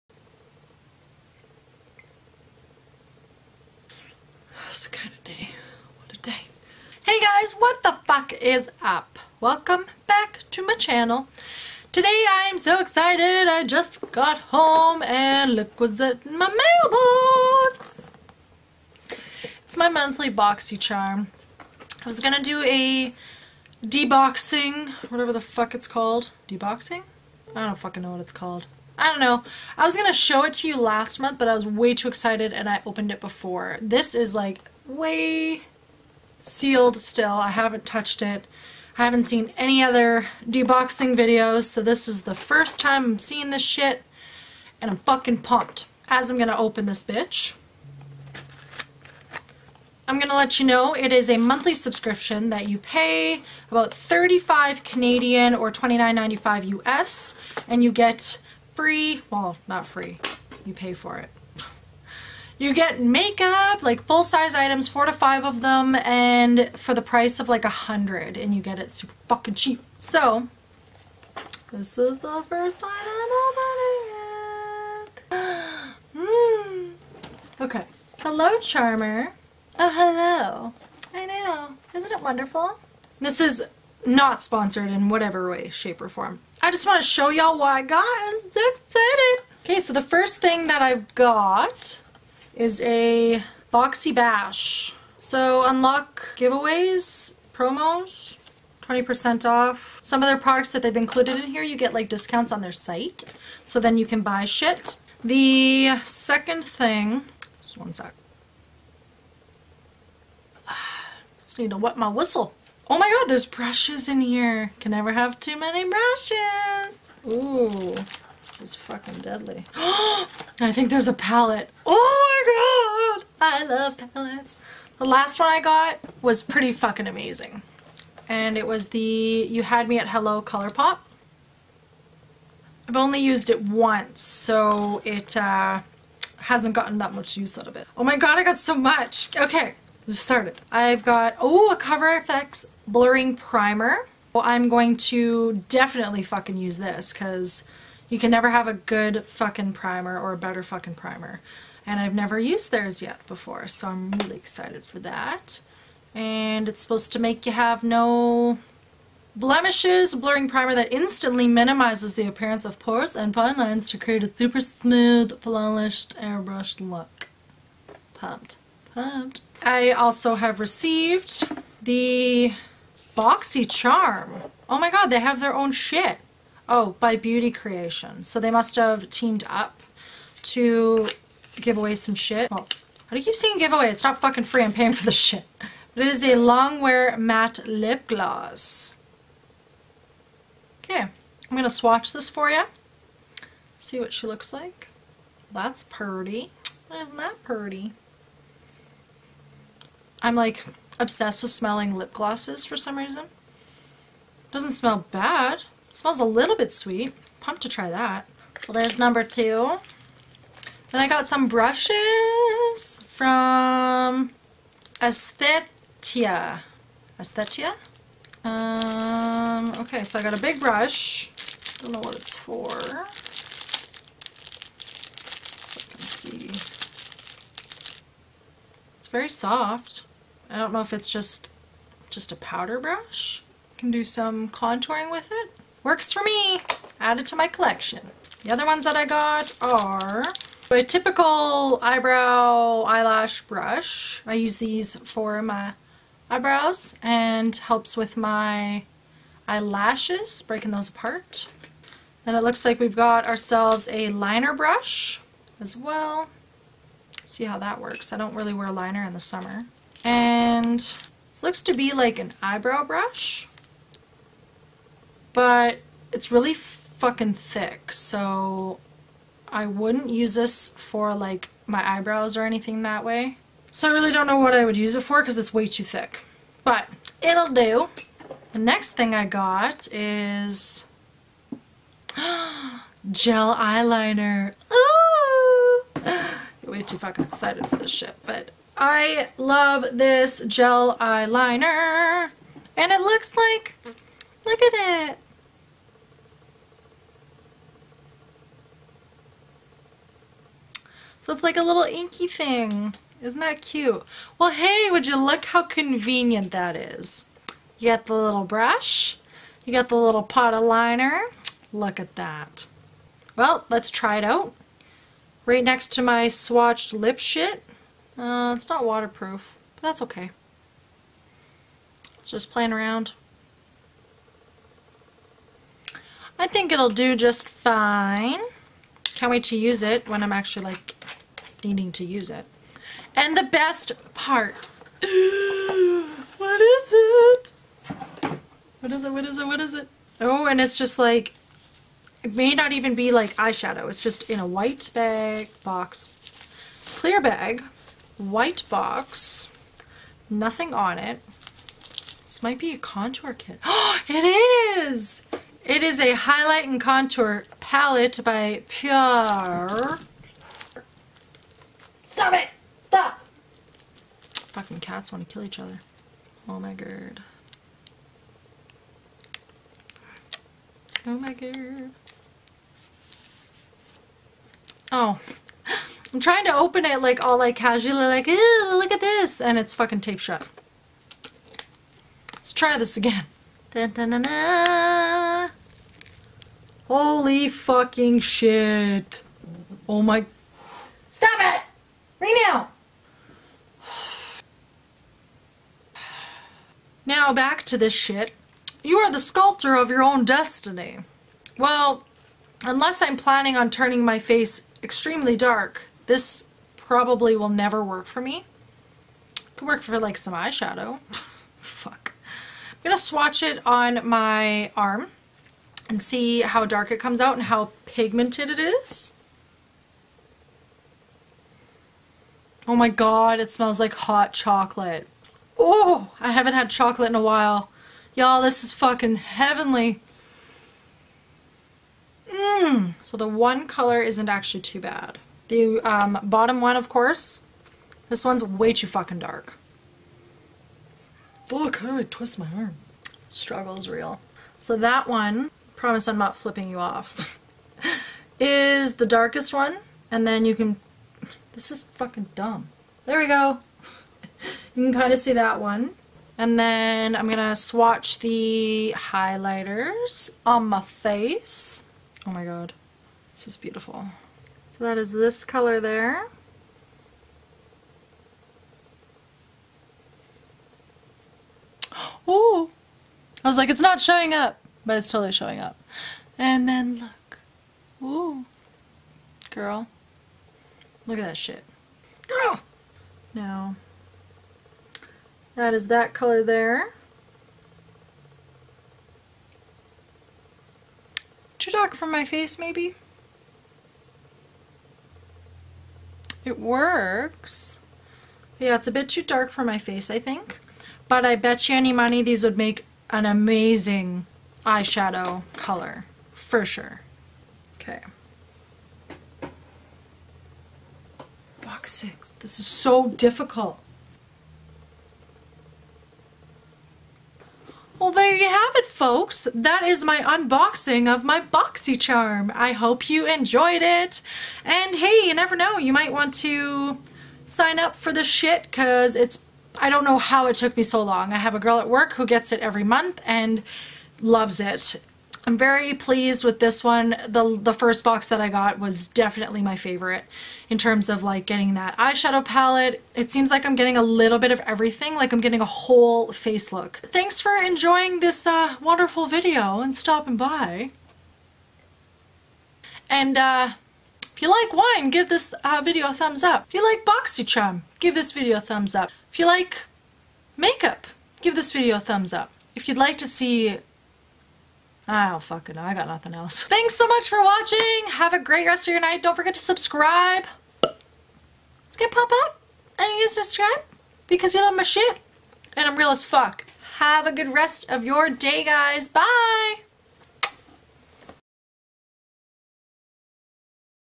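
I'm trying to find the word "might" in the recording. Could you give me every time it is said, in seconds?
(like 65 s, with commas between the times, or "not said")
352 s, 525 s.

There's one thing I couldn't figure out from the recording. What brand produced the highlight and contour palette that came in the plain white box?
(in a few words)
Pure.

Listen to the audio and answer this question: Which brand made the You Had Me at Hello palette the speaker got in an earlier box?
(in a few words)
Colourpop.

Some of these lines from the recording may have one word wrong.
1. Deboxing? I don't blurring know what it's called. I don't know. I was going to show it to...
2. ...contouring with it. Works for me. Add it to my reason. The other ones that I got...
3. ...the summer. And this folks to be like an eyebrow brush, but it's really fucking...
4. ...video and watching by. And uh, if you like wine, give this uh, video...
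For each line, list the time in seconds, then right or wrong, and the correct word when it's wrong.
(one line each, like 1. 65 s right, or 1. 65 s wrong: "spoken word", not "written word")
1. 26 s wrong: "fucking", not "blurring"
2. 234 s wrong: "collection", not "reason"
3. 259 s wrong: "looks", not "folks"
4. 549 s wrong: "stopping", not "watching".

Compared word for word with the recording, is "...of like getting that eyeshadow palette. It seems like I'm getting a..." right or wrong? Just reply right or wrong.
right.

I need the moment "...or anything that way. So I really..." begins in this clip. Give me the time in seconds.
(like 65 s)
272 s.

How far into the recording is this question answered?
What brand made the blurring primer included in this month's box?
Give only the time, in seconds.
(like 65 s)
141 s.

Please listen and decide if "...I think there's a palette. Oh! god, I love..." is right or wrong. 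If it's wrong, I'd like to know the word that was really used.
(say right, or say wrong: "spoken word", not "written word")
right.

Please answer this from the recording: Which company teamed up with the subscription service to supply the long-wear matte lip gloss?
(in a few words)
Beauty Creation.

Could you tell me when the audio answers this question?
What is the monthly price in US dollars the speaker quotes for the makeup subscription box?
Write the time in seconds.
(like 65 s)
55 s.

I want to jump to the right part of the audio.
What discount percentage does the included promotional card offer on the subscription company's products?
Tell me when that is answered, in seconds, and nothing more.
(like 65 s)
98 s.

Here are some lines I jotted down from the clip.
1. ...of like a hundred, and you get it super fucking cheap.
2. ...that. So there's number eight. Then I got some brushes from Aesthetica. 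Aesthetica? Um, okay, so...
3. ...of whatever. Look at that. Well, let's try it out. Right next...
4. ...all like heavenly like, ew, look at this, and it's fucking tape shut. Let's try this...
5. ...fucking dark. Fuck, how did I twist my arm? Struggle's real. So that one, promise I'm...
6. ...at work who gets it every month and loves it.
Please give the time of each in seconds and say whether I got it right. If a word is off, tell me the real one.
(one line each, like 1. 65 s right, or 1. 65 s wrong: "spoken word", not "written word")
1. 67 s right
2. 207 s wrong: "two", not "eight"
3. 310 s wrong: "liner", not "whatever"
4. 377 s wrong: "casually", not "heavenly"
5. 438 s right
6. 531 s right.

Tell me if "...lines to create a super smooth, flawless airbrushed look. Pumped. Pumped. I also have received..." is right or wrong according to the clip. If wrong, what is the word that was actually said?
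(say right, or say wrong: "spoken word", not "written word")
right.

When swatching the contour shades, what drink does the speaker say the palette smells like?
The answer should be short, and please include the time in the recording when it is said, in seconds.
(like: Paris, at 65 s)
hot chocolate, at 423 s.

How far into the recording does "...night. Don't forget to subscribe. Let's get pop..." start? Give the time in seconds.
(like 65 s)
569 s.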